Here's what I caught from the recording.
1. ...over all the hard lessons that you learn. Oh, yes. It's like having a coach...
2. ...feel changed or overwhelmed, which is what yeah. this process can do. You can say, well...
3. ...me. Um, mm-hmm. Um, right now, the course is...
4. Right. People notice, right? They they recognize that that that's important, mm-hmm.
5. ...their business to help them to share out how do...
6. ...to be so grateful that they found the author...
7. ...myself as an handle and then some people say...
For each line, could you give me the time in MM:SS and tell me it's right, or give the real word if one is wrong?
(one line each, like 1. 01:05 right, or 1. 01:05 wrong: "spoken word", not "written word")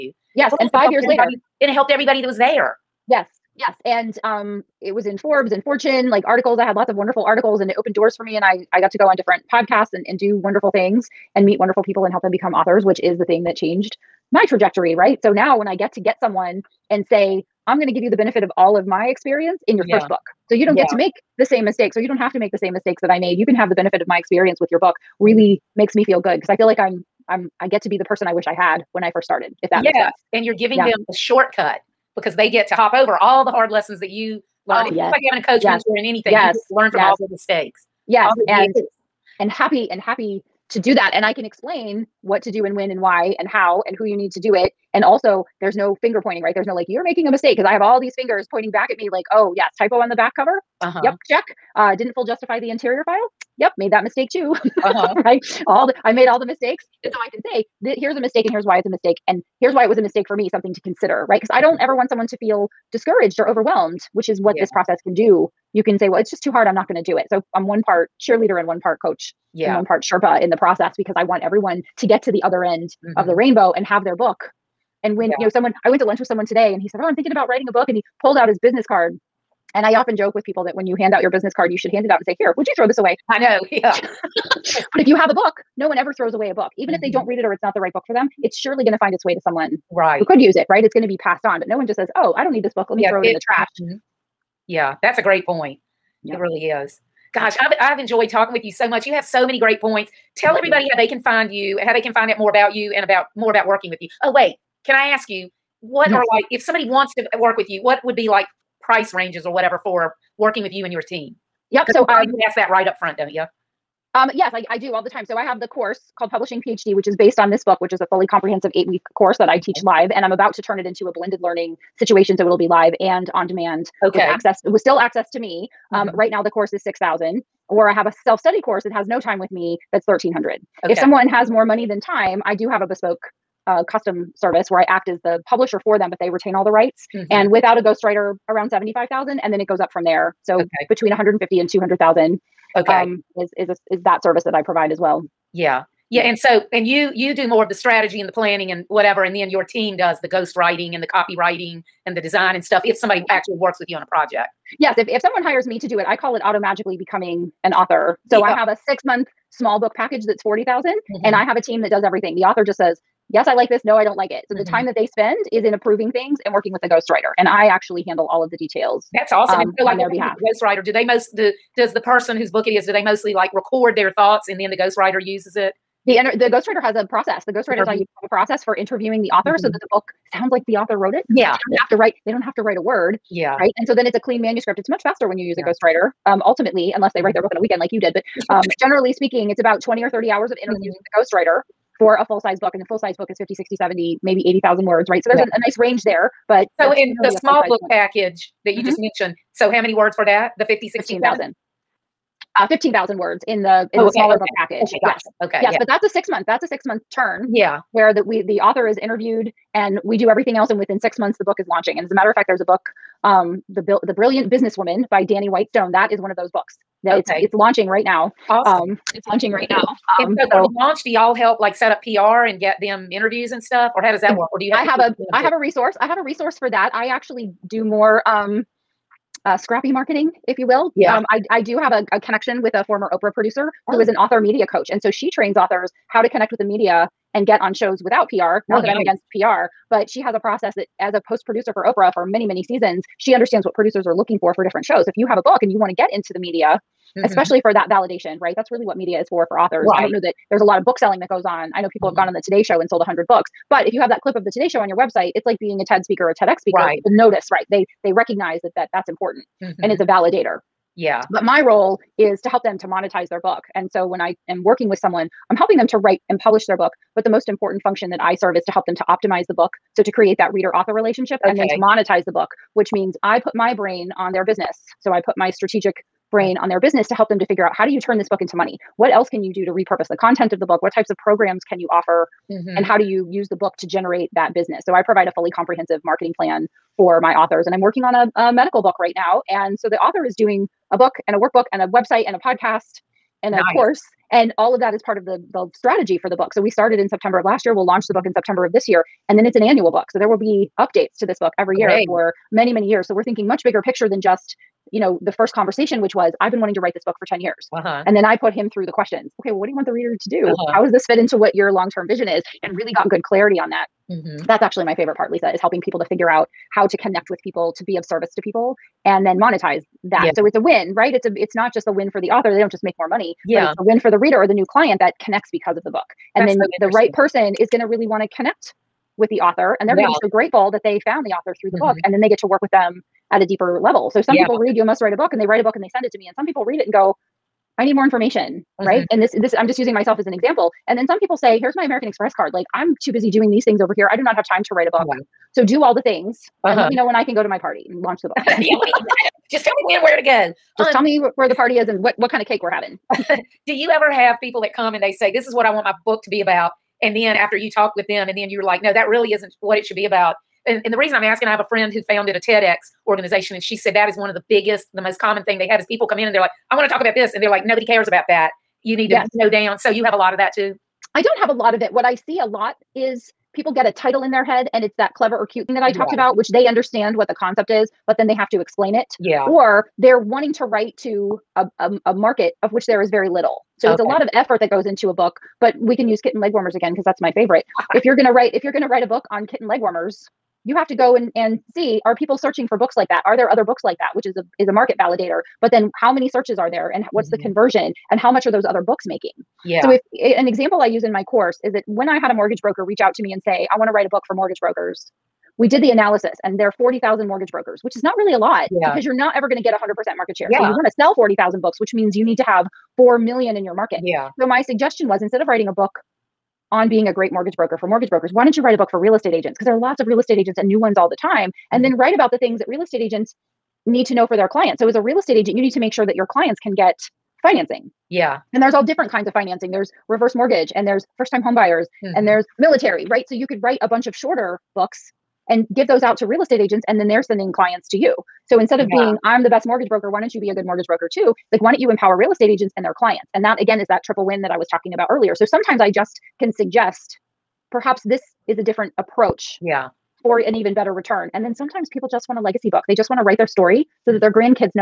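1. 00:32 right
2. 01:02 wrong: "discouraged", not "changed"
3. 02:05 right
4. 04:16 right
5. 04:36 wrong: "figure", not "share"
6. 05:30 right
7. 05:39 wrong: "example", not "handle".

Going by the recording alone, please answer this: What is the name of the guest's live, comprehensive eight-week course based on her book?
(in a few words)
Publishing PhD.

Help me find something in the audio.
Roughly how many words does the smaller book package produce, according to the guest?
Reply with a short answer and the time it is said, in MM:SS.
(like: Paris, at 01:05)
15,000 words, at 03:22.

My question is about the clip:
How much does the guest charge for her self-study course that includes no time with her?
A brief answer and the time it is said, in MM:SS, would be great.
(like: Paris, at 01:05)
1,300, at 02:10.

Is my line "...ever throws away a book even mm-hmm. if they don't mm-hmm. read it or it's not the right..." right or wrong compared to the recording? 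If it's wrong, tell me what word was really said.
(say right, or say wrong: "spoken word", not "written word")
right.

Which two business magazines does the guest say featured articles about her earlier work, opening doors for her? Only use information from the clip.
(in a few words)
Forbes and Fortune.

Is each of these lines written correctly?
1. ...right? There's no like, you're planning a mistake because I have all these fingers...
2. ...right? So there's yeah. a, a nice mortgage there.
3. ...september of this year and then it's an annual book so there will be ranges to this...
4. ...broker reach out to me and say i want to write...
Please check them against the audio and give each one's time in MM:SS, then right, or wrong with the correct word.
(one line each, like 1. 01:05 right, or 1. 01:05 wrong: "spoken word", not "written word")
1. 00:46 wrong: "making", not "planning"
2. 03:15 wrong: "range", not "mortgage"
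3. 04:58 wrong: "updates", not "ranges"
4. 06:42 right.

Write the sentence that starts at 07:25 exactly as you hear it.
So sometimes I just can suggest perhaps this is a different approach.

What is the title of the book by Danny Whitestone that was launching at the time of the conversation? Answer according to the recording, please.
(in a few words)
The Brilliant Businesswoman.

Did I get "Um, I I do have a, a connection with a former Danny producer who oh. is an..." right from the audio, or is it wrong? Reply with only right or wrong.
wrong.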